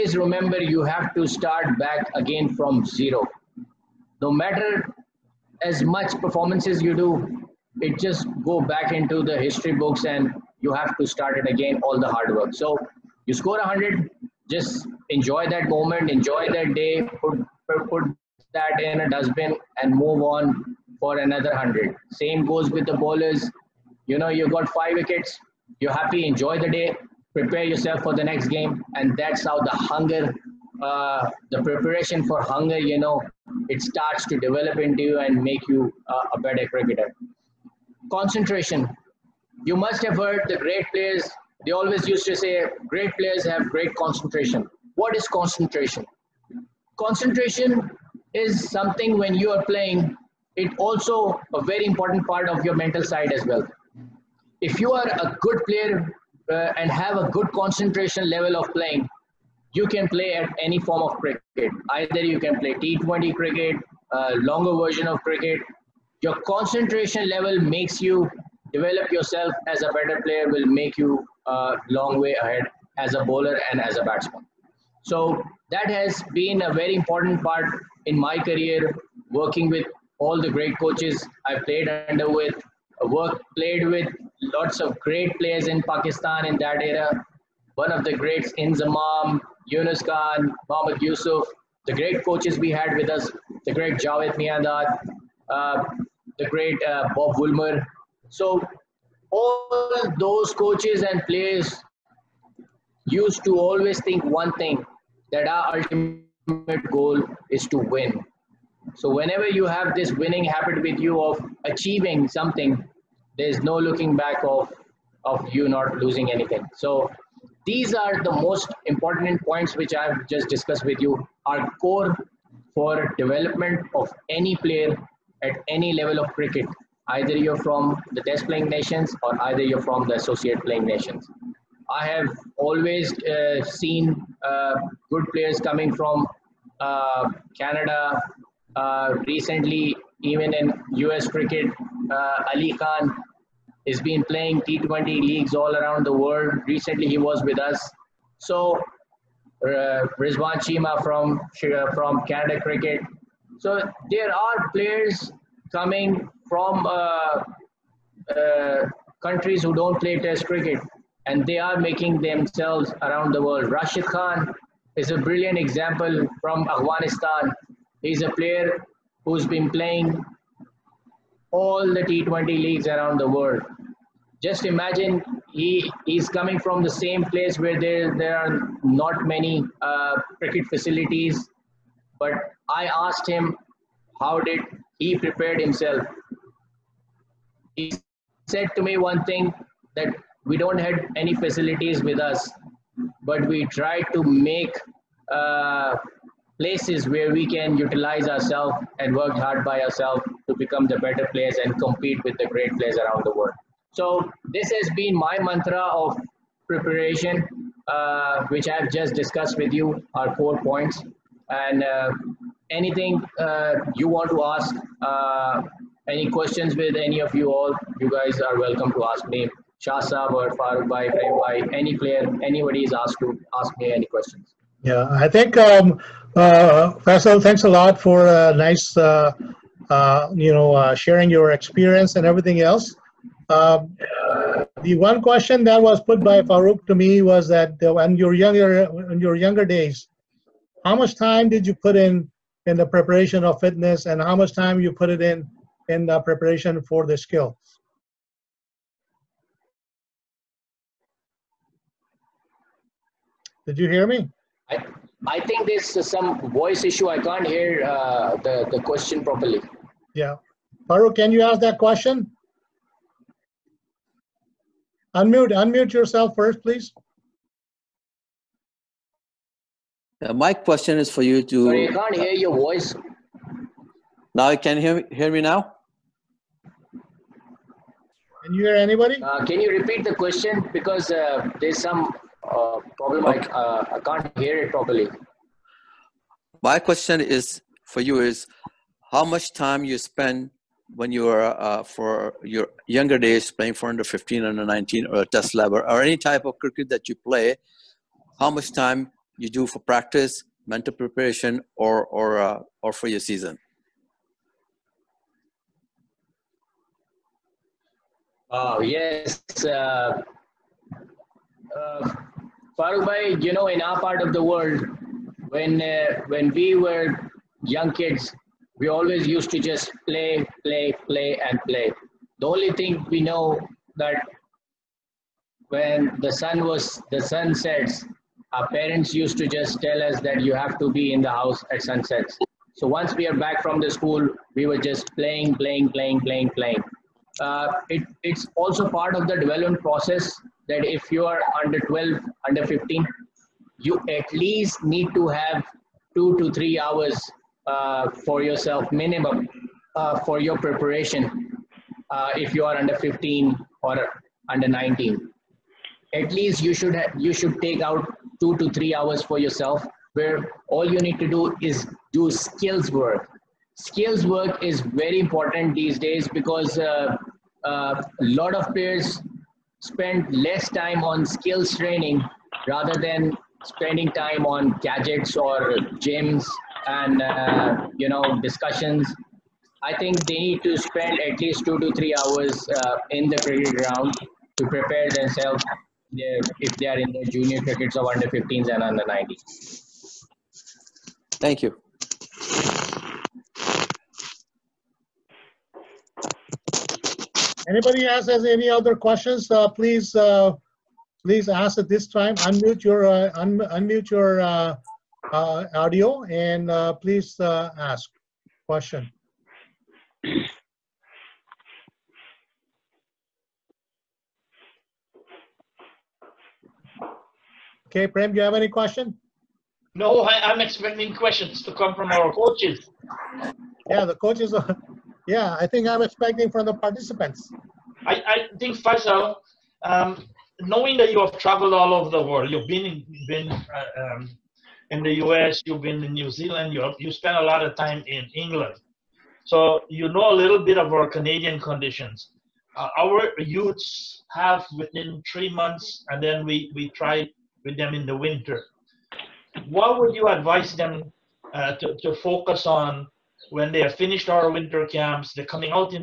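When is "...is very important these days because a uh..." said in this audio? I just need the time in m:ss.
6:04.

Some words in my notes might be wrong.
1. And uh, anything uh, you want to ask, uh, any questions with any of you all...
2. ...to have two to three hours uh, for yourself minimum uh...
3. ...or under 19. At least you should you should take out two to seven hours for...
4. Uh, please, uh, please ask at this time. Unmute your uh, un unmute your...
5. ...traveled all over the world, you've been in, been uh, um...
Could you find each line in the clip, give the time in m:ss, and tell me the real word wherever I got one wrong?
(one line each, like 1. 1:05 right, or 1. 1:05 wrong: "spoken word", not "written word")
1. 3:31 right
2. 5:45 right
3. 5:53 wrong: "three", not "seven"
4. 6:39 right
5. 7:11 right.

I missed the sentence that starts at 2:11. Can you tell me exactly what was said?
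I have always uh, seen uh, good players coming from uh, Canada.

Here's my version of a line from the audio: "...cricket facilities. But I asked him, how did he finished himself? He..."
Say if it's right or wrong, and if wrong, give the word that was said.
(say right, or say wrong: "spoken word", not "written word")
wrong: "prepared", not "finished".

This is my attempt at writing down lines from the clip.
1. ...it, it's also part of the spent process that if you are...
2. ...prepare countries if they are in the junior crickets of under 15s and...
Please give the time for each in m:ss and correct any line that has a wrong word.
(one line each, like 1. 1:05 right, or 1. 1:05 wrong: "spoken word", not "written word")
1. 5:37 wrong: "development", not "spent"
2. 6:24 wrong: "themselves", not "countries".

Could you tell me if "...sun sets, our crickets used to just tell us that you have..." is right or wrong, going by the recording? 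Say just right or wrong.
wrong.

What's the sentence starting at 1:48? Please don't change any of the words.
So whenever you have this winning habit with you of achieving something, there's no looking back of, of you not losing anything.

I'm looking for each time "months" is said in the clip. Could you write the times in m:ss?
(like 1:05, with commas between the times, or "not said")
7:25.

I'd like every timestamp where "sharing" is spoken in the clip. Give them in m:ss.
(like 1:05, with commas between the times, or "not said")
3:50.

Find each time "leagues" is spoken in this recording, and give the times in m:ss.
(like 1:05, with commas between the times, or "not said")
2:25, 2:52.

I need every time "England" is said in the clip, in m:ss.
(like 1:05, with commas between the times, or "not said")
7:18.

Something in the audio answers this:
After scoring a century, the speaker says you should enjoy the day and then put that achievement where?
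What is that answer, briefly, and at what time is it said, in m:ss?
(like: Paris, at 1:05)
In a dustbin, at 0:19.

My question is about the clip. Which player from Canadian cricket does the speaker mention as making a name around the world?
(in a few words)
Rizwan Cheema.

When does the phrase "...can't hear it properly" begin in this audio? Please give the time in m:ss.
4:43.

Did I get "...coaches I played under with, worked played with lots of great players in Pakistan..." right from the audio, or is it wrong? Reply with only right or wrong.
right.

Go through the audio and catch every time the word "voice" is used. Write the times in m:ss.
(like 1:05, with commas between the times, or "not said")
4:16, 4:32.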